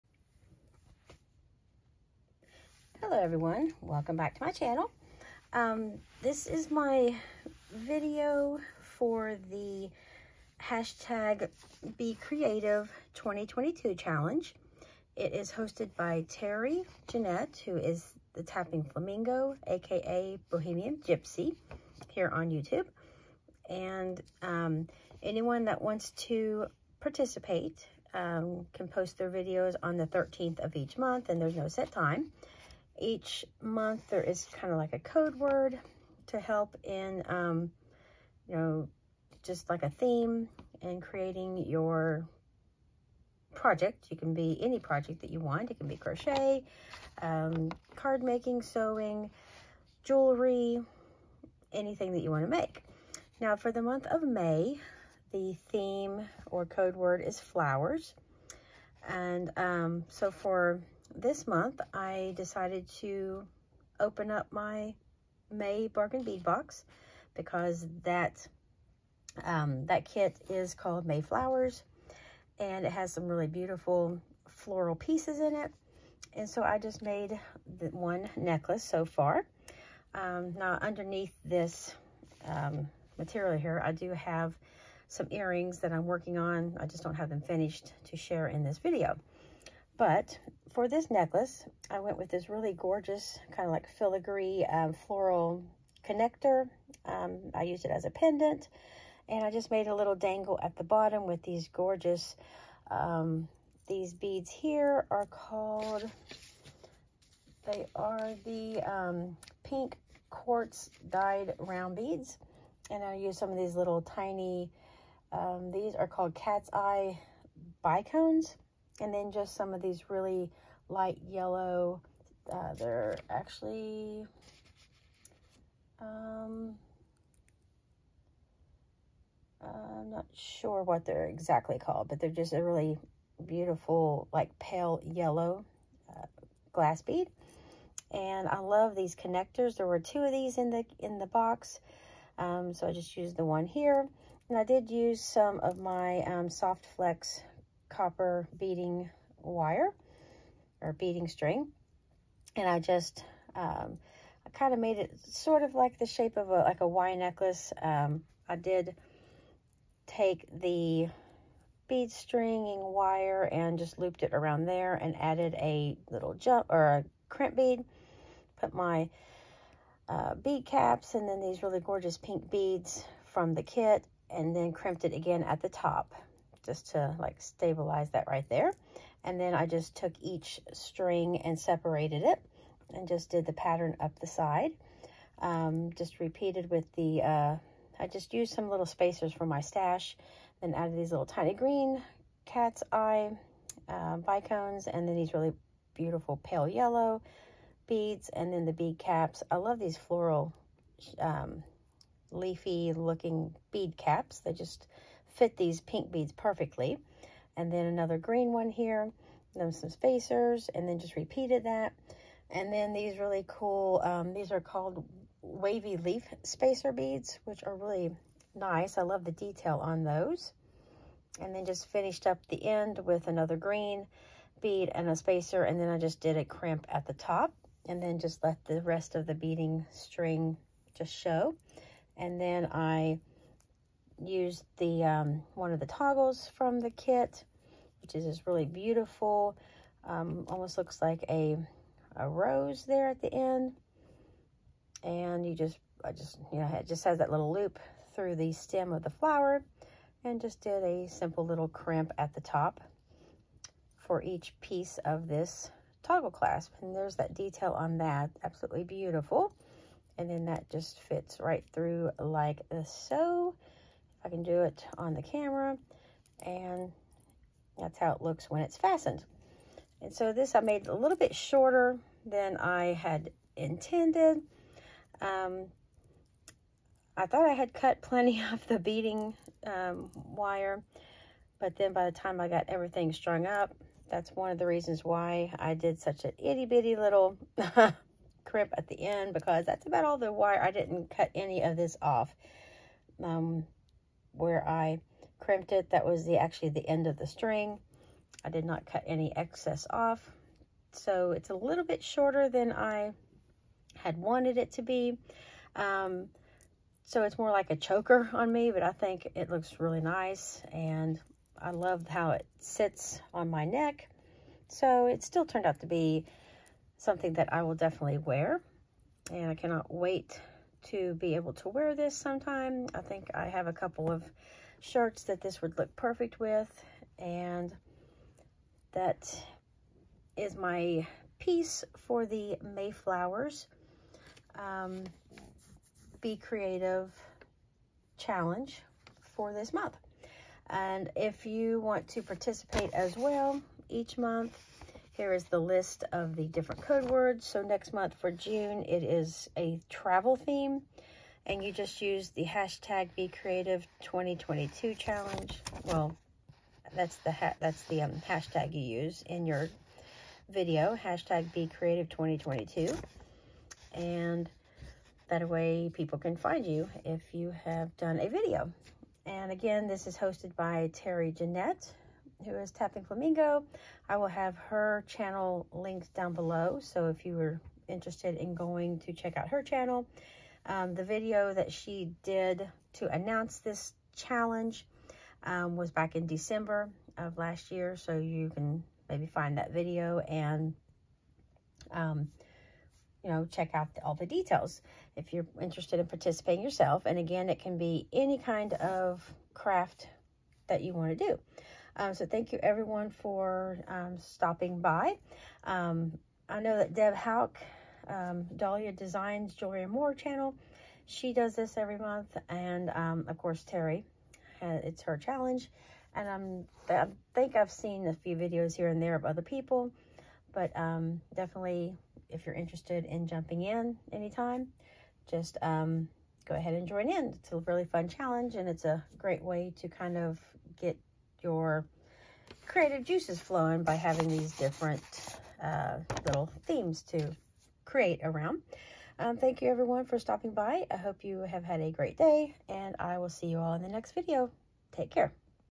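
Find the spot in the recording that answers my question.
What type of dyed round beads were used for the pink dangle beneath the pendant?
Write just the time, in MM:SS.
01:49.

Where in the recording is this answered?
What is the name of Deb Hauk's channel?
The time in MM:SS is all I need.
06:48.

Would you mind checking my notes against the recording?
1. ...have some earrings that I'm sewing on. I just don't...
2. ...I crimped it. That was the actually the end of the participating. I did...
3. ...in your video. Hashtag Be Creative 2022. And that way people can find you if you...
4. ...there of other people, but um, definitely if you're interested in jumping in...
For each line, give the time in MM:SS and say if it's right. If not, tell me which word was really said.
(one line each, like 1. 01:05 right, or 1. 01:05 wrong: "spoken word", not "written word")
1. 01:24 wrong: "working", not "sewing"
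2. 04:54 wrong: "string", not "participating"
3. 05:59 right
4. 06:58 right.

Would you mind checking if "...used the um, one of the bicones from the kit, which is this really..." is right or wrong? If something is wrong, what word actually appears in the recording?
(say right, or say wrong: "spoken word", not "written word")
wrong: "toggles", not "bicones".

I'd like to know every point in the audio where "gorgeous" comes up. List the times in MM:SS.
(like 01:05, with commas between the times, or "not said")
01:32, 01:41, 02:51.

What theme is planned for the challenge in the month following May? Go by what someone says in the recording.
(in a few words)
Travel.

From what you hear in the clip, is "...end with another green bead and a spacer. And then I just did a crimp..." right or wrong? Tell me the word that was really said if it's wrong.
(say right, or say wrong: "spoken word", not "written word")
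right.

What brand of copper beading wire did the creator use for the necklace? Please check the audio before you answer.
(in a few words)
Soft Flex.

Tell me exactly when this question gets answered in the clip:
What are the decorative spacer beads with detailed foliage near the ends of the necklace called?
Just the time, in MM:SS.
03:35.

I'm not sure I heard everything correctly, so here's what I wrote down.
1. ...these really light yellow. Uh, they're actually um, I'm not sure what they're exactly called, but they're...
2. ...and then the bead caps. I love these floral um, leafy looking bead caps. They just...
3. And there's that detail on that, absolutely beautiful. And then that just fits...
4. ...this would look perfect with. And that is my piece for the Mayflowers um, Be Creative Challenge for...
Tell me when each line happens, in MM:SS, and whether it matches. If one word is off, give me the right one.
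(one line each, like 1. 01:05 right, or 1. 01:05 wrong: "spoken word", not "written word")
1. 01:59 right
2. 03:18 right
3. 04:16 right
4. 05:25 right.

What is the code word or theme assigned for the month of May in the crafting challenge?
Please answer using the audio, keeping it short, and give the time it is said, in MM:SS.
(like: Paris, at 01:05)
Flowers, at 00:57.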